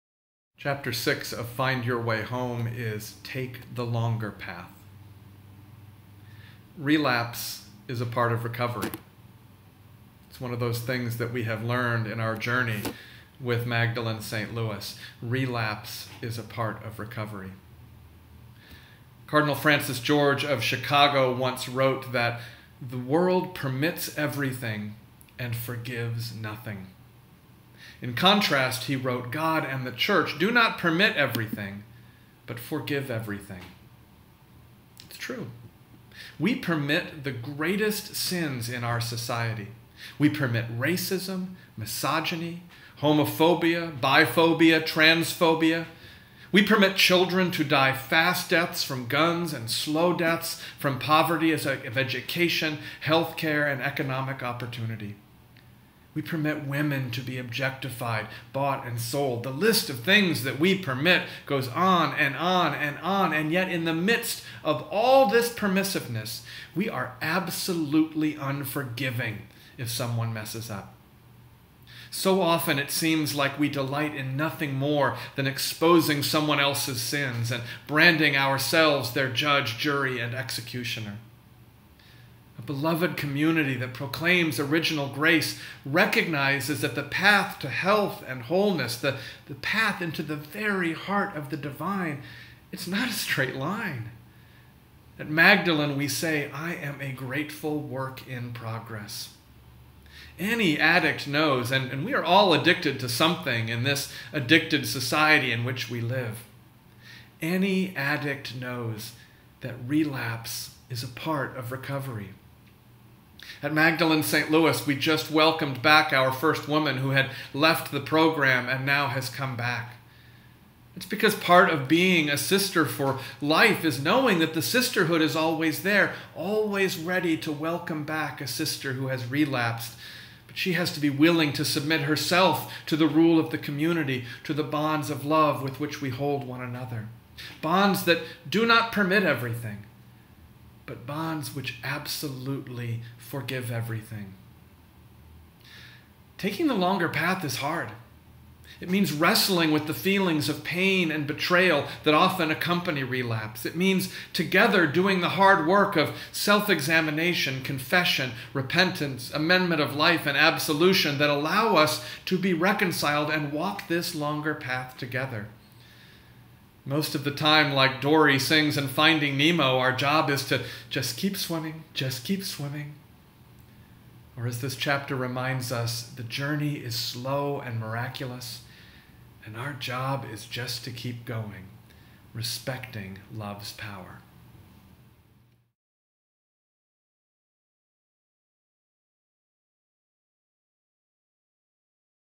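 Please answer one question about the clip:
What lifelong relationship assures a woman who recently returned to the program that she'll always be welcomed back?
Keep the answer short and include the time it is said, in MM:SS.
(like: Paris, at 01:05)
sister for life, at 02:02.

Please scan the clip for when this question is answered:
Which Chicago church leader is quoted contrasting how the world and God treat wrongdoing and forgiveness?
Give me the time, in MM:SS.
00:19.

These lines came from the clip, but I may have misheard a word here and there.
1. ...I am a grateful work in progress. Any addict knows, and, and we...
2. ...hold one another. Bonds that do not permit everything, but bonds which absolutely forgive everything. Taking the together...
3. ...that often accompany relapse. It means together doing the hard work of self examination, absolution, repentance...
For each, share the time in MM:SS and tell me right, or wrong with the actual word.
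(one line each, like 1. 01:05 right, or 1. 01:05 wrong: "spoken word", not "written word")
1. 01:36 right
2. 02:16 wrong: "longer", not "together"
3. 02:32 wrong: "confession", not "absolution".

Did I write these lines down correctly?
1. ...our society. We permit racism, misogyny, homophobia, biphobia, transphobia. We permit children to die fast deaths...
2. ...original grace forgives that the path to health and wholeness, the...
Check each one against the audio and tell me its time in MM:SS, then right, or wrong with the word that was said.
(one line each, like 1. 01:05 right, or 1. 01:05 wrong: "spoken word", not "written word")
1. 00:38 right
2. 01:24 wrong: "recognizes", not "forgives".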